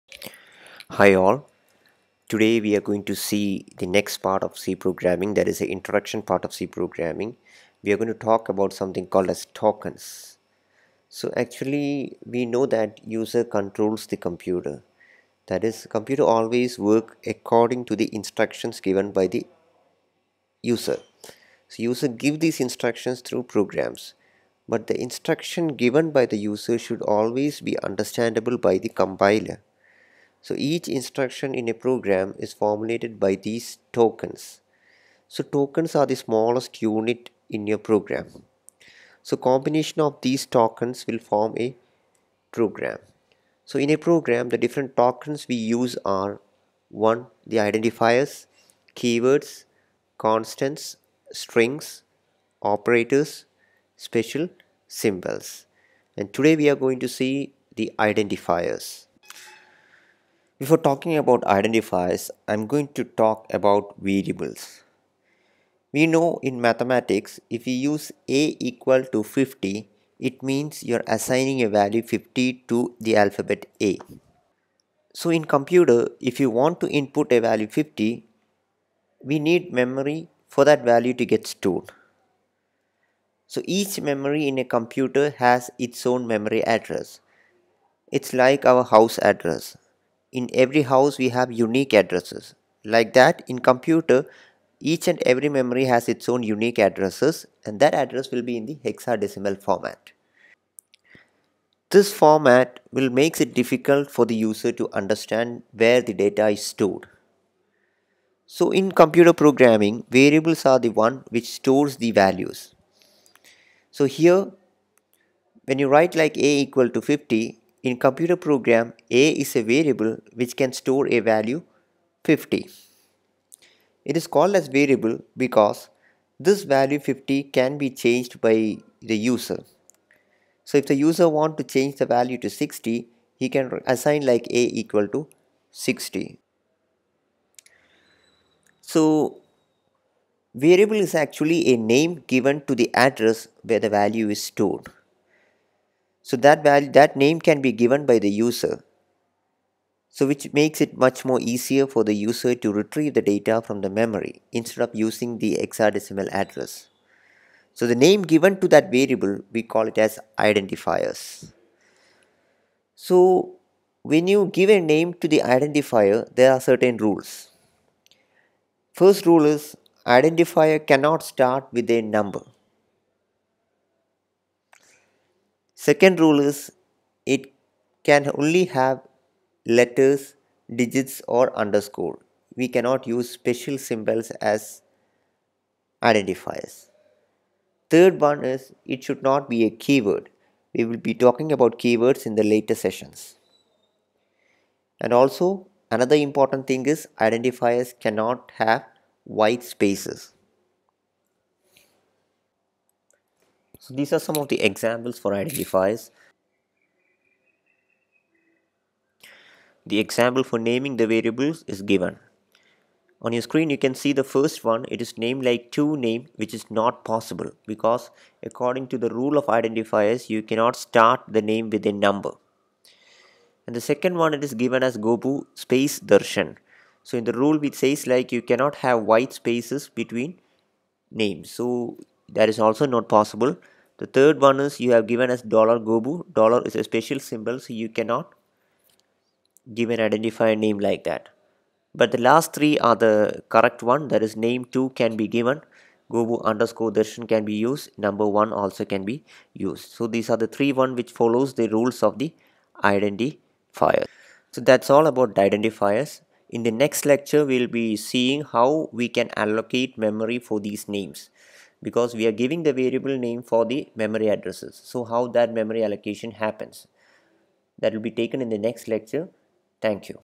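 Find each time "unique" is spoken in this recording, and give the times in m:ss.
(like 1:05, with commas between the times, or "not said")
1:31, 1:36.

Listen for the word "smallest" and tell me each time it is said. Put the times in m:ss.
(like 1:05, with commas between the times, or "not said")
0:36.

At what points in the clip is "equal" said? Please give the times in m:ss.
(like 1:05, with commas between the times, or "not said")
1:08, 1:56, 2:14.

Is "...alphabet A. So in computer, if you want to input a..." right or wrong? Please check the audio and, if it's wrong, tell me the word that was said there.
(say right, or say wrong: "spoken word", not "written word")
right.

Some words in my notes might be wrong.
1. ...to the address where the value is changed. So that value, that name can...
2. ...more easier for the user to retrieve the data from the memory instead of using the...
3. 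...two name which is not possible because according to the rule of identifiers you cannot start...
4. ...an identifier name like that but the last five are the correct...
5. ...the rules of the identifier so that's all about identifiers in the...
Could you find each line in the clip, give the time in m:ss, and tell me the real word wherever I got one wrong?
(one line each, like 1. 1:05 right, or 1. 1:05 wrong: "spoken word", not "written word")
1. 2:22 wrong: "stored", not "changed"
2. 2:31 right
3. 3:35 right
4. 3:59 wrong: "three", not "five"
5. 4:11 right.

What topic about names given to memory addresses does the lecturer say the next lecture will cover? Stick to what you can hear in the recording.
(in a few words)
memory allocation.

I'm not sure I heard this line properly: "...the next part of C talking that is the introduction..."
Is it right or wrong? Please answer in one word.
wrong.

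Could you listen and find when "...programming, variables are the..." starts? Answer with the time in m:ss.
1:49.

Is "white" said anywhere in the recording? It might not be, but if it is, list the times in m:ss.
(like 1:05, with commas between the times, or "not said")
3:19, 3:49.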